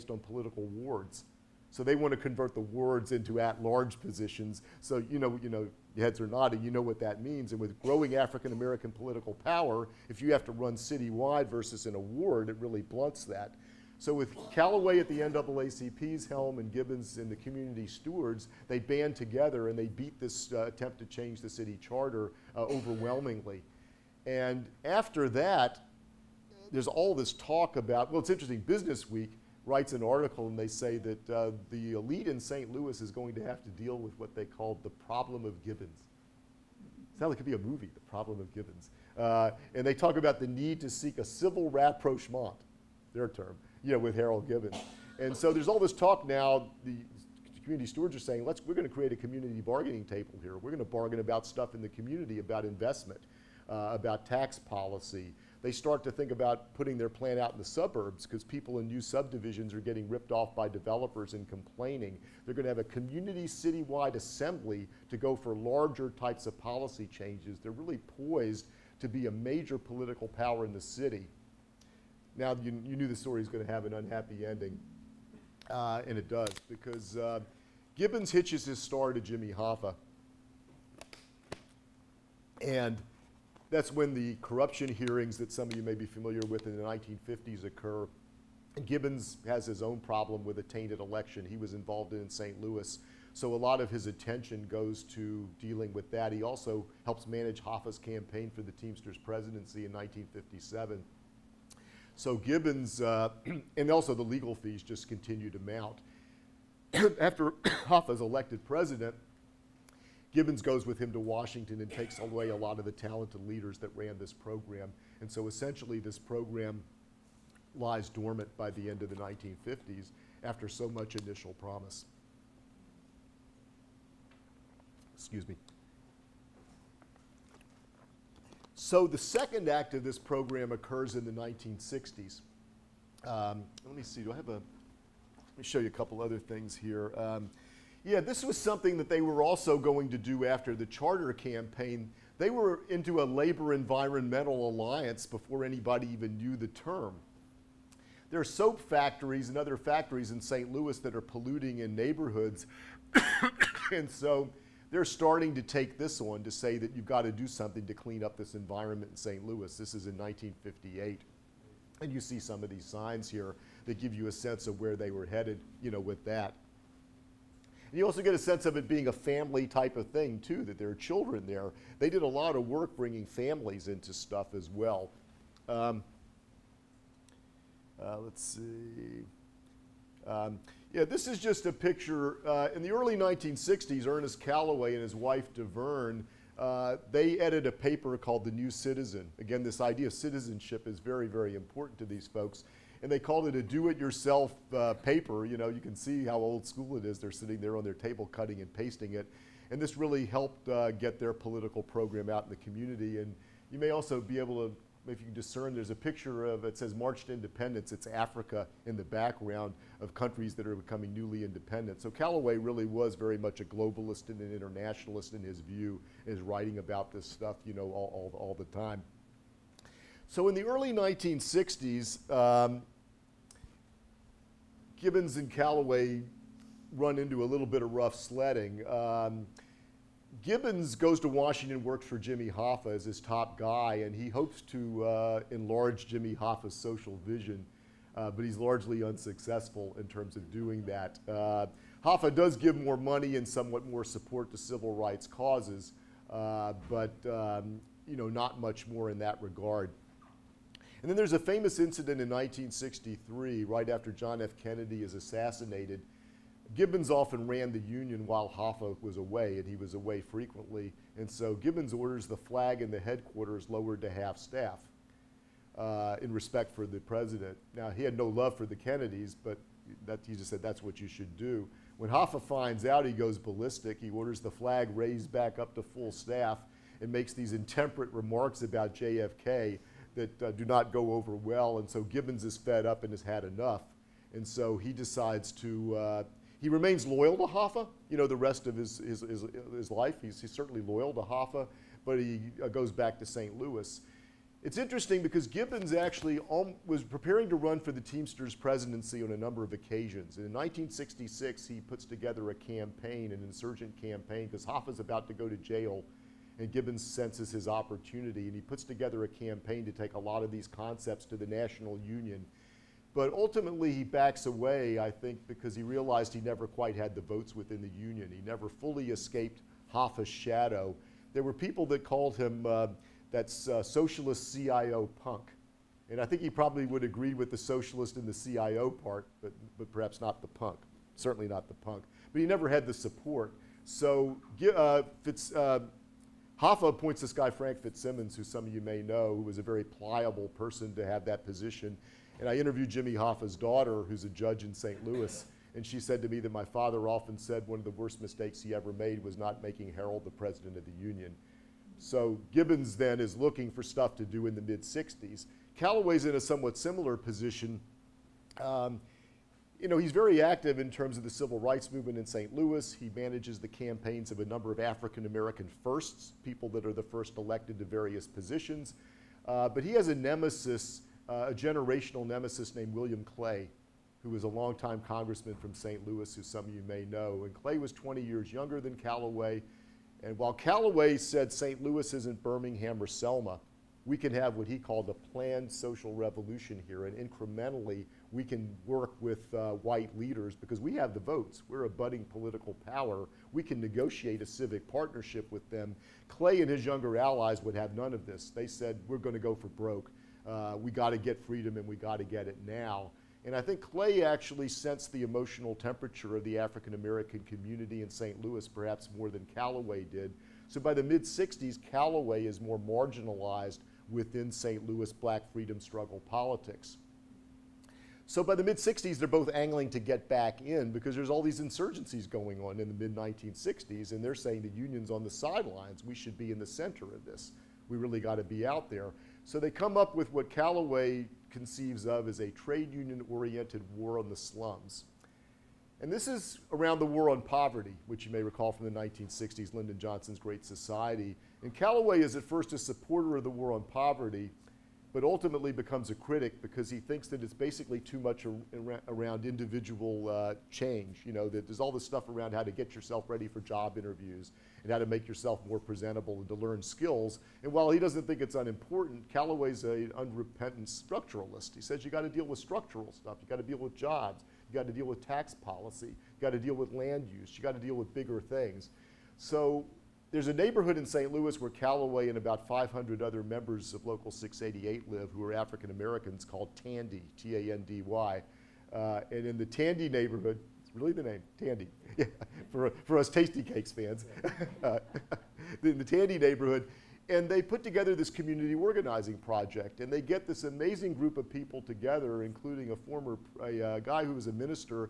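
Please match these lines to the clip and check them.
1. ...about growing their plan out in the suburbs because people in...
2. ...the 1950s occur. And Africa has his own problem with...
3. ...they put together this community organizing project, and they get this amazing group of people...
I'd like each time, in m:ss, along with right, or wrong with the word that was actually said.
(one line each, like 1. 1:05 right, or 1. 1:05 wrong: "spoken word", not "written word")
1. 0:56 wrong: "putting", not "growing"
2. 1:26 wrong: "Gibbons", not "Africa"
3. 8:07 right.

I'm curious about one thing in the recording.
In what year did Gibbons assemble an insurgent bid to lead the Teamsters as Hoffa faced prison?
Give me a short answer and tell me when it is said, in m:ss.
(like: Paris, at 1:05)
1966, at 5:00.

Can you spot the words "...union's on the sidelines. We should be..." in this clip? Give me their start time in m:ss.
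7:04.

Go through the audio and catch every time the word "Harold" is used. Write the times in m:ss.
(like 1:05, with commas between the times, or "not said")
0:44, 5:49.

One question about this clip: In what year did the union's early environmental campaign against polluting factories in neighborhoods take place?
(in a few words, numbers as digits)
1958.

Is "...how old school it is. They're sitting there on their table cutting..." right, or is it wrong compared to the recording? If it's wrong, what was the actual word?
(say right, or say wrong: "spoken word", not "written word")
right.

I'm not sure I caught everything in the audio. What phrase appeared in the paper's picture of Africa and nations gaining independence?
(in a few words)
March to Independence.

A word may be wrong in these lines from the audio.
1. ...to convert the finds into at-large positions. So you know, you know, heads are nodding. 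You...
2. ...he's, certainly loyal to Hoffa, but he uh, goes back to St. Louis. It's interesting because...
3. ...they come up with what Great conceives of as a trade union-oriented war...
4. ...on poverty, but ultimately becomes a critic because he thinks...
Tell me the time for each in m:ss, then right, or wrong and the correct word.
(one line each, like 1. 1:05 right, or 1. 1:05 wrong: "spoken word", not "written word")
1. 0:02 wrong: "wards", not "finds"
2. 4:50 right
3. 7:09 wrong: "Calloway", not "Great"
4. 7:23 right.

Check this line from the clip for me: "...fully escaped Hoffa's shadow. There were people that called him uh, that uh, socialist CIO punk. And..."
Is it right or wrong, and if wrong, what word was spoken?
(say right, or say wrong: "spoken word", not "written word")
right.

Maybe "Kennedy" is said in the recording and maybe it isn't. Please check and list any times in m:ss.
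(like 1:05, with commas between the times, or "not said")
4:14, 4:28.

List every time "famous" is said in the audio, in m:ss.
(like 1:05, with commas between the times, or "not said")
4:11.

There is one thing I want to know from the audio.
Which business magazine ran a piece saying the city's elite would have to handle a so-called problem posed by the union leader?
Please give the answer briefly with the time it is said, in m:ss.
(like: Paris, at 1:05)
Business Week, at 0:28.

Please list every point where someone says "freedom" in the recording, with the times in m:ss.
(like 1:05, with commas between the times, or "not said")
6:41, 6:55.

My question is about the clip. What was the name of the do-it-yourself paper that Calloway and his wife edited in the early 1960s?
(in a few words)
The New Citizen.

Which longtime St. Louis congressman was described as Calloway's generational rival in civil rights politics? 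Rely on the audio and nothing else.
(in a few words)
William Clay.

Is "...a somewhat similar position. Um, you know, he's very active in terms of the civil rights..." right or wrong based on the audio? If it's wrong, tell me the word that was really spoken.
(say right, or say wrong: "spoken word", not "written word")
right.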